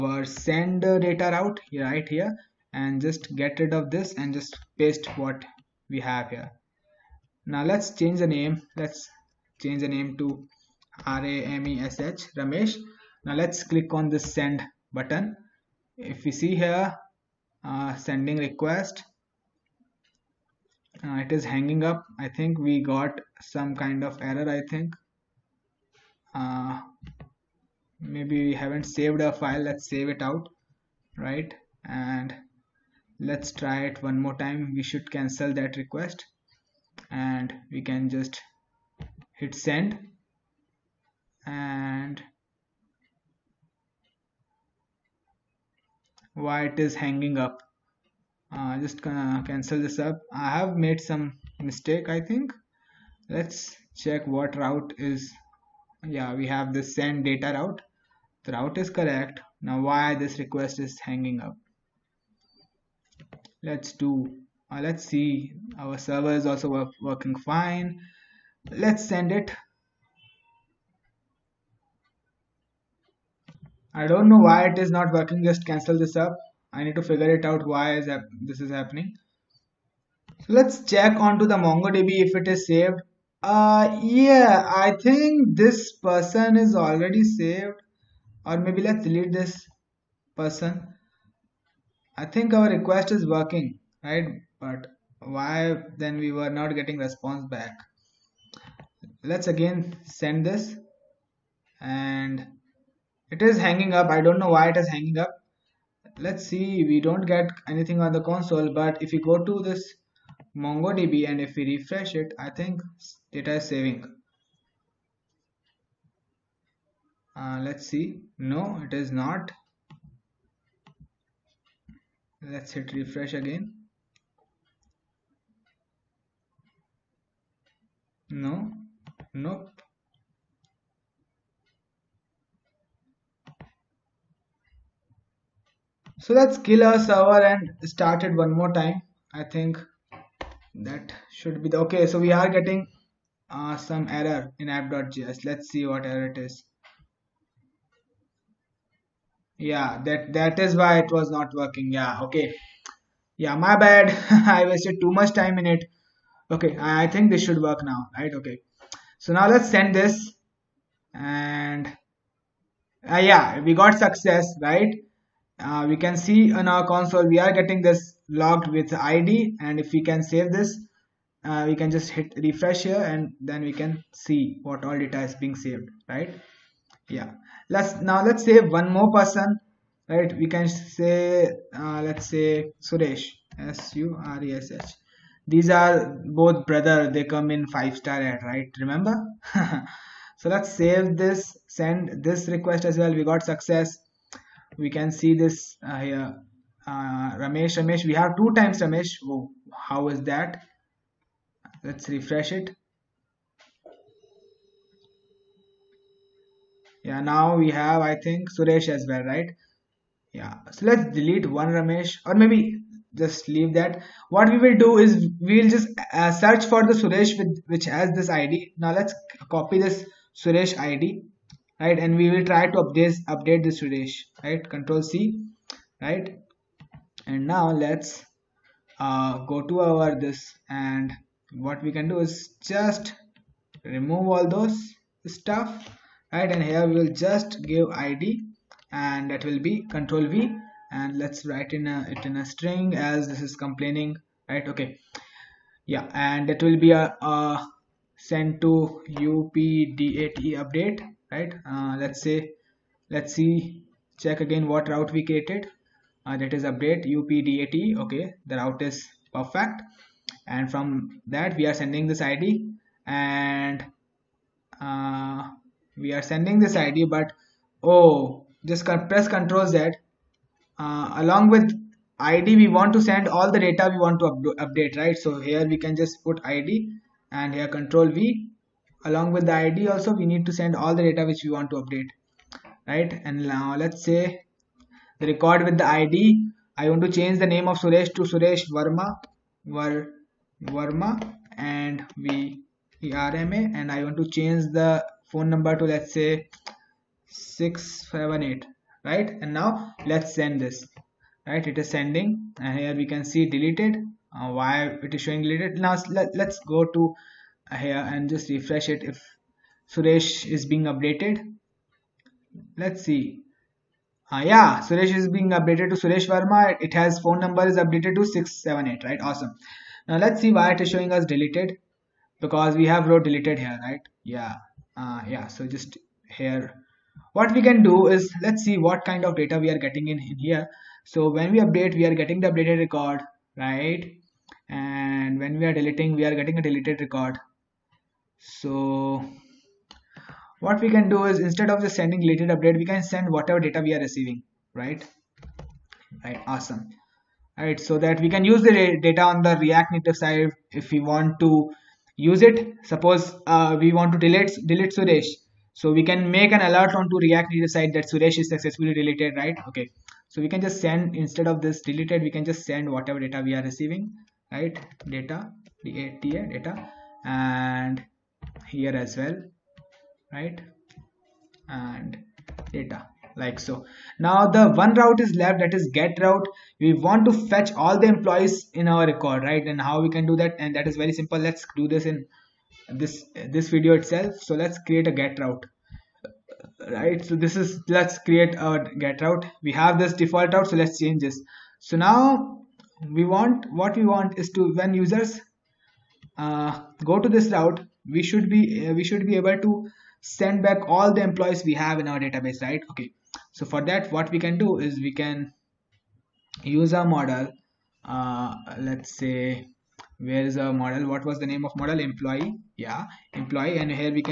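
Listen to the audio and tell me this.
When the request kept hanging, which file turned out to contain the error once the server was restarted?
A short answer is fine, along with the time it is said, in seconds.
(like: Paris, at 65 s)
app.js, at 144 s.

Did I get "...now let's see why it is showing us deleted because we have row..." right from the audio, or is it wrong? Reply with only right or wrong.
right.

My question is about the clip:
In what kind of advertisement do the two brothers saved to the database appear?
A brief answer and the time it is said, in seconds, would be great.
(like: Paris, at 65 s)
five star ad, at 187 s.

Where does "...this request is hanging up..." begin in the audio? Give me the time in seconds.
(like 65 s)
60 s.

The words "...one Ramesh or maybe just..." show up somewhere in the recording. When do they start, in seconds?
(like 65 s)
211 s.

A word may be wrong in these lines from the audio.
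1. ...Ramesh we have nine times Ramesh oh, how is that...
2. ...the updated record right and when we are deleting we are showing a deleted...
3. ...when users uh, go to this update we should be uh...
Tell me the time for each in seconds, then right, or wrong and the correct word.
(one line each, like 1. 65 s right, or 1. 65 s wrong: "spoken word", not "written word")
1. 197 s wrong: "two", not "nine"
2. 332 s wrong: "getting", not "showing"
3. 394 s wrong: "route", not "update".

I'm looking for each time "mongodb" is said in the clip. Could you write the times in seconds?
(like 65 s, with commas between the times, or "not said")
81 s, 110 s.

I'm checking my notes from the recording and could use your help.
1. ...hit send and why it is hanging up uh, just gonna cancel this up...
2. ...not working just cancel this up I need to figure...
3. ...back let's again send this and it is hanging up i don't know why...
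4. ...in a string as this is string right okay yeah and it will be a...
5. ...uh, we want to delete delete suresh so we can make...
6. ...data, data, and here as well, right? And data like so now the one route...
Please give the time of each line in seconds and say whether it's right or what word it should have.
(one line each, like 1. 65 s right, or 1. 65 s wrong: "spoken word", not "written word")
1. 39 s right
2. 74 s right
3. 97 s right
4. 242 s wrong: "complaining", not "string"
5. 353 s right
6. 365 s right.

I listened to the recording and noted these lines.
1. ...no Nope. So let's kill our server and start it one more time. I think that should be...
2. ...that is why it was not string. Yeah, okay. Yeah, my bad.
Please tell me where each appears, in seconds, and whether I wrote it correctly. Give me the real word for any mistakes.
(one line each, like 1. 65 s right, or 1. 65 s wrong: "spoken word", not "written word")
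1. 128 s right
2. 150 s wrong: "working", not "string".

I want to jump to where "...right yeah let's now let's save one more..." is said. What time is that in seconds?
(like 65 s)
176 s.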